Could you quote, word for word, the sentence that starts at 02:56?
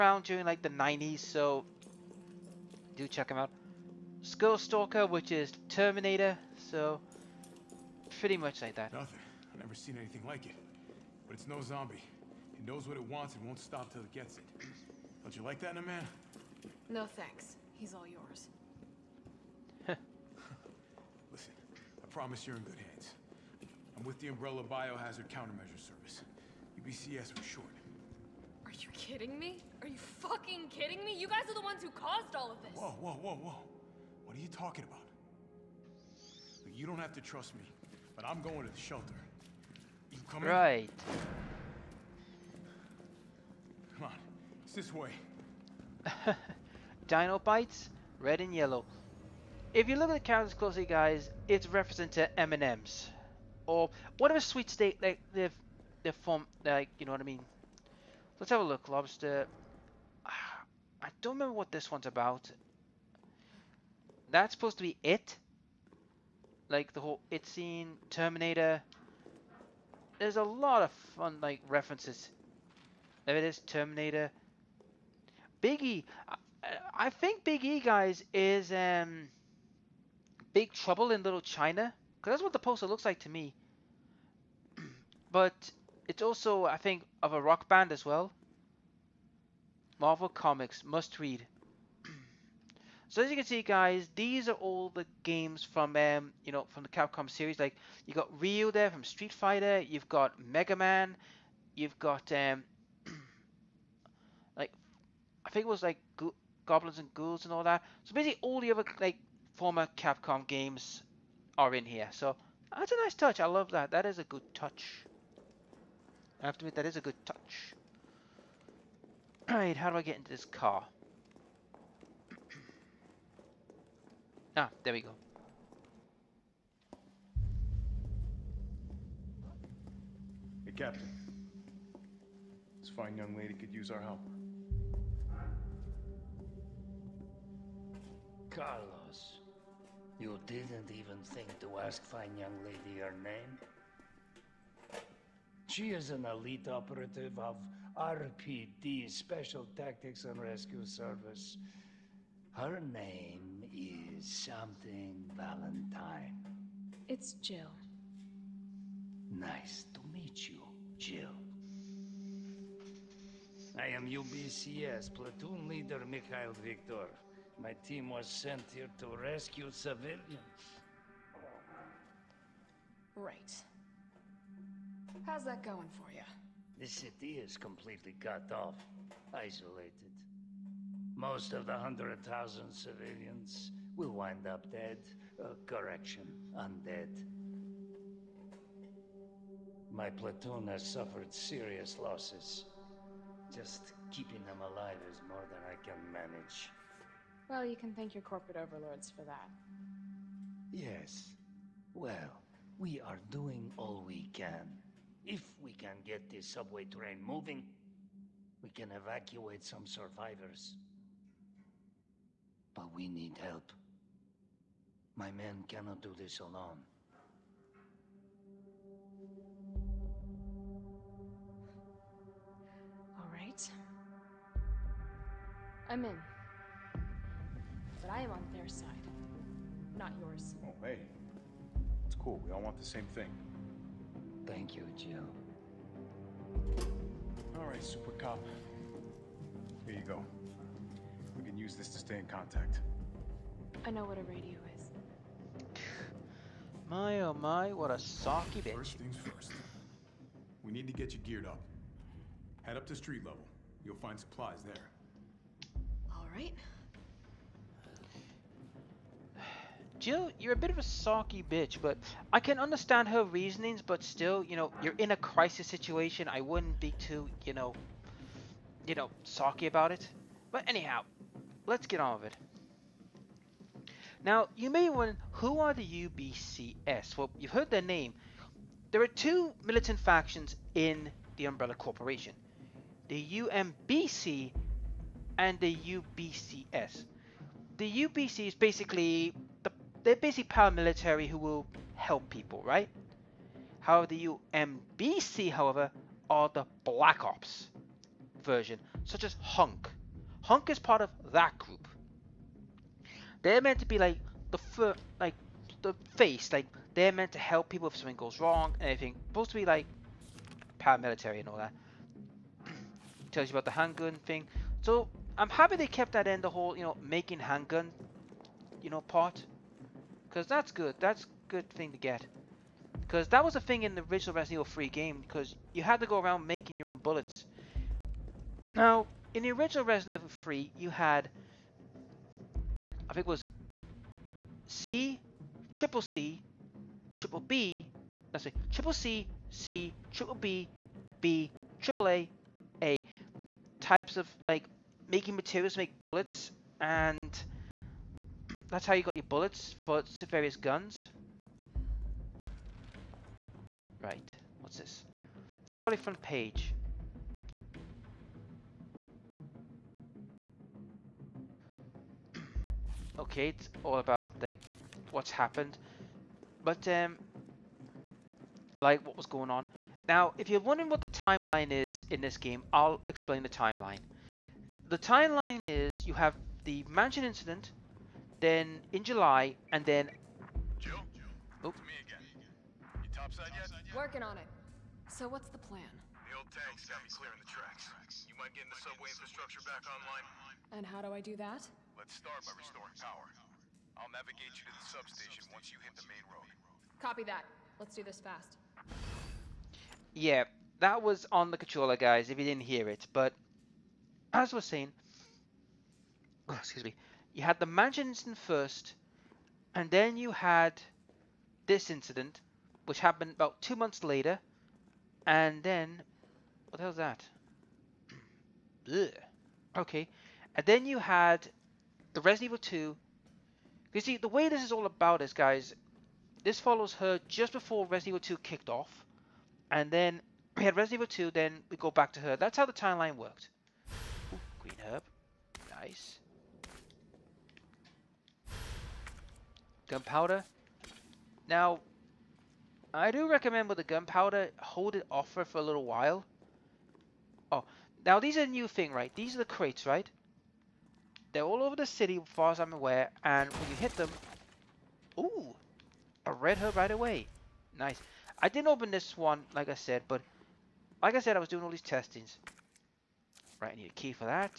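The city is completely cut off, isolated.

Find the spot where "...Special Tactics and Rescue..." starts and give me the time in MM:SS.
02:29.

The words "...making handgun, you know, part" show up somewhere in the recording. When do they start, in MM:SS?
05:17.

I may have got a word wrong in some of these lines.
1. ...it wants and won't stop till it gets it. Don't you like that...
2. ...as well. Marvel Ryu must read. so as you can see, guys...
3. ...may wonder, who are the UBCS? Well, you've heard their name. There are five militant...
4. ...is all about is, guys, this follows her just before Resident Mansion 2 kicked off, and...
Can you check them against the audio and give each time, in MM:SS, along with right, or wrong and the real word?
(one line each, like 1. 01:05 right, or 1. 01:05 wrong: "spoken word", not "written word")
1. 00:12 right
2. 01:27 wrong: "Comics", not "Ryu"
3. 04:34 wrong: "two", not "five"
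4. 07:04 wrong: "Evil", not "Mansion".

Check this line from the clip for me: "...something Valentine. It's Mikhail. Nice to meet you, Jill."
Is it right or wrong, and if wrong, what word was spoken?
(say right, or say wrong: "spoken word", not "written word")
wrong: "Jill", not "Mikhail".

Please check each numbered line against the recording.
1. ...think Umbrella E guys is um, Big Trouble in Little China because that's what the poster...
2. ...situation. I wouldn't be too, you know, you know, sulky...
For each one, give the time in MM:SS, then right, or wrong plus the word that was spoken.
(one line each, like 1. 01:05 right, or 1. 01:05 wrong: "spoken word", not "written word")
1. 01:17 wrong: "Big", not "Umbrella"
2. 04:25 right.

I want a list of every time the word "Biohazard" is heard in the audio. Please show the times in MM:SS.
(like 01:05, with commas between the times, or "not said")
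00:24.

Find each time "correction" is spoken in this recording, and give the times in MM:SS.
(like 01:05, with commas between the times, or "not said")
03:05.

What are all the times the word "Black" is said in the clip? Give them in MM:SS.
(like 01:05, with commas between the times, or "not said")
04:56.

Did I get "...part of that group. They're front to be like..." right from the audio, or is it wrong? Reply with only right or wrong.
wrong.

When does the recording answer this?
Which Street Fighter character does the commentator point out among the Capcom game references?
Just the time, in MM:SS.
01:38.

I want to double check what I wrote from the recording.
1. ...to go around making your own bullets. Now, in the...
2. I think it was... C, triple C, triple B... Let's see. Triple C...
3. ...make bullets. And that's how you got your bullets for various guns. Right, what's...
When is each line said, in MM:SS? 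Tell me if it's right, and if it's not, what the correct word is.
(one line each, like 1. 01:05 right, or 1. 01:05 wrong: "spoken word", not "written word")
1. 05:26 right
2. 05:33 right
3. 05:45 right.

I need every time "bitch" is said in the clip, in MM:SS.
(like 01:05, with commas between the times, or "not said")
04:08, 04:21.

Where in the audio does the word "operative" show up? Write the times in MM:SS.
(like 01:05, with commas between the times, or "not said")
02:26.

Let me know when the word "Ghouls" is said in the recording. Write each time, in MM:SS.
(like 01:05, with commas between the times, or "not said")
01:47.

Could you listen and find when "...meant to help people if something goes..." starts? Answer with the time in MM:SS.
05:07.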